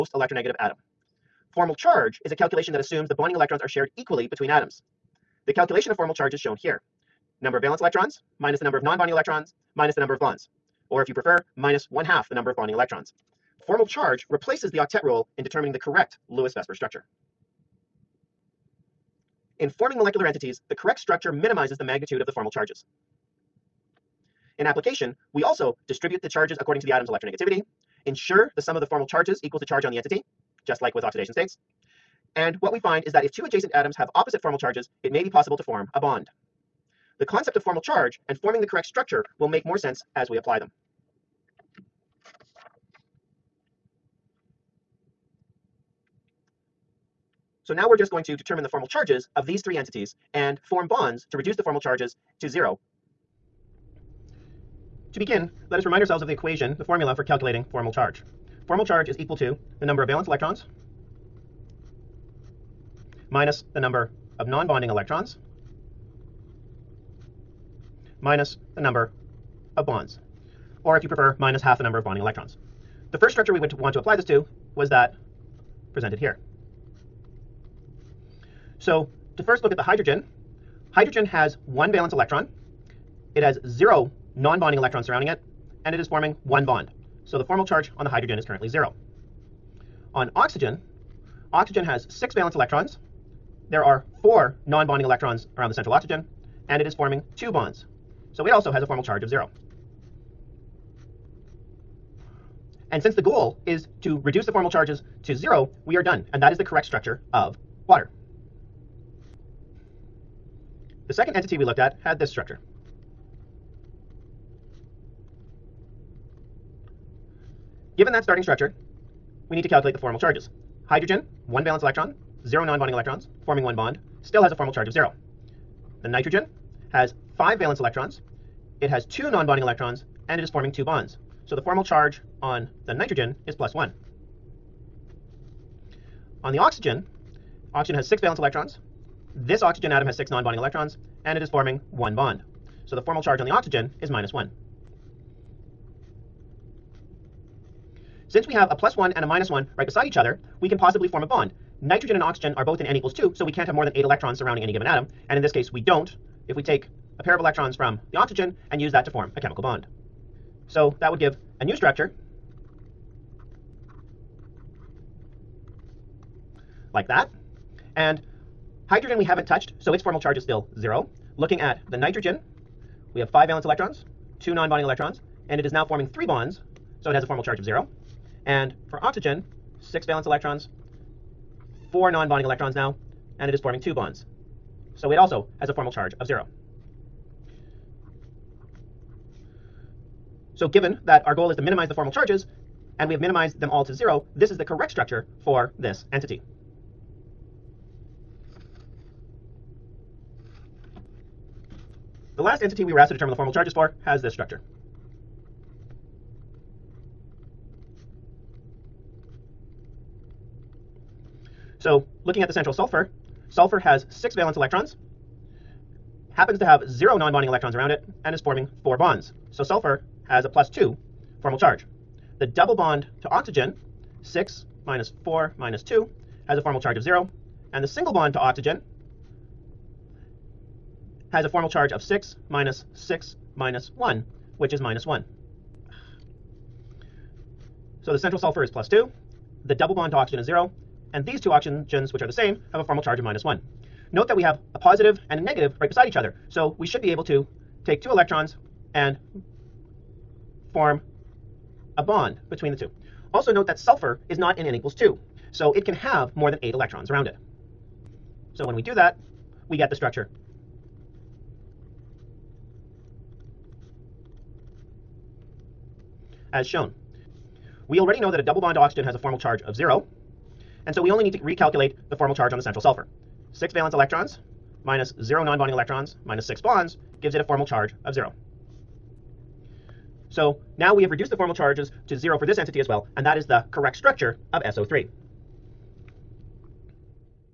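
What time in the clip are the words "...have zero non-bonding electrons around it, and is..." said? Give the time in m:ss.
3:36.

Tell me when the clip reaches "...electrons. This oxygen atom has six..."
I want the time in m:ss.
2:18.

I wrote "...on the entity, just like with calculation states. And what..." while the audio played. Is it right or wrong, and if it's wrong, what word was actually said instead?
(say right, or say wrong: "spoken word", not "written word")
wrong: "oxidation", not "calculation".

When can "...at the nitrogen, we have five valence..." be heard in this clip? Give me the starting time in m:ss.
2:51.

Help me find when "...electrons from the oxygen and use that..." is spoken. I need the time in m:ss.
2:37.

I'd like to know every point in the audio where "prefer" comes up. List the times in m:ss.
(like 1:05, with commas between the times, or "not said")
0:11, 1:11.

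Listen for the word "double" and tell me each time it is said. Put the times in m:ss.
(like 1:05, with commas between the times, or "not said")
3:42, 3:59, 4:28.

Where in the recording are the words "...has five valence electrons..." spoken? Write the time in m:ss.
2:06.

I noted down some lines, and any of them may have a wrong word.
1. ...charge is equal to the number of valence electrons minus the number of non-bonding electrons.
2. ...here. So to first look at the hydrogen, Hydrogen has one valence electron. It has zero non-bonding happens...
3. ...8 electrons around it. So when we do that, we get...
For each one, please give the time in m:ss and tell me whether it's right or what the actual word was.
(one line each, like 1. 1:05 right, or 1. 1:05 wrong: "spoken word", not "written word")
1. 0:58 right
2. 1:16 wrong: "electrons", not "happens"
3. 4:16 right.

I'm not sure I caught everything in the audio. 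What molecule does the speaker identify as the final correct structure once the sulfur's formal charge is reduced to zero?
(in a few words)
SO3.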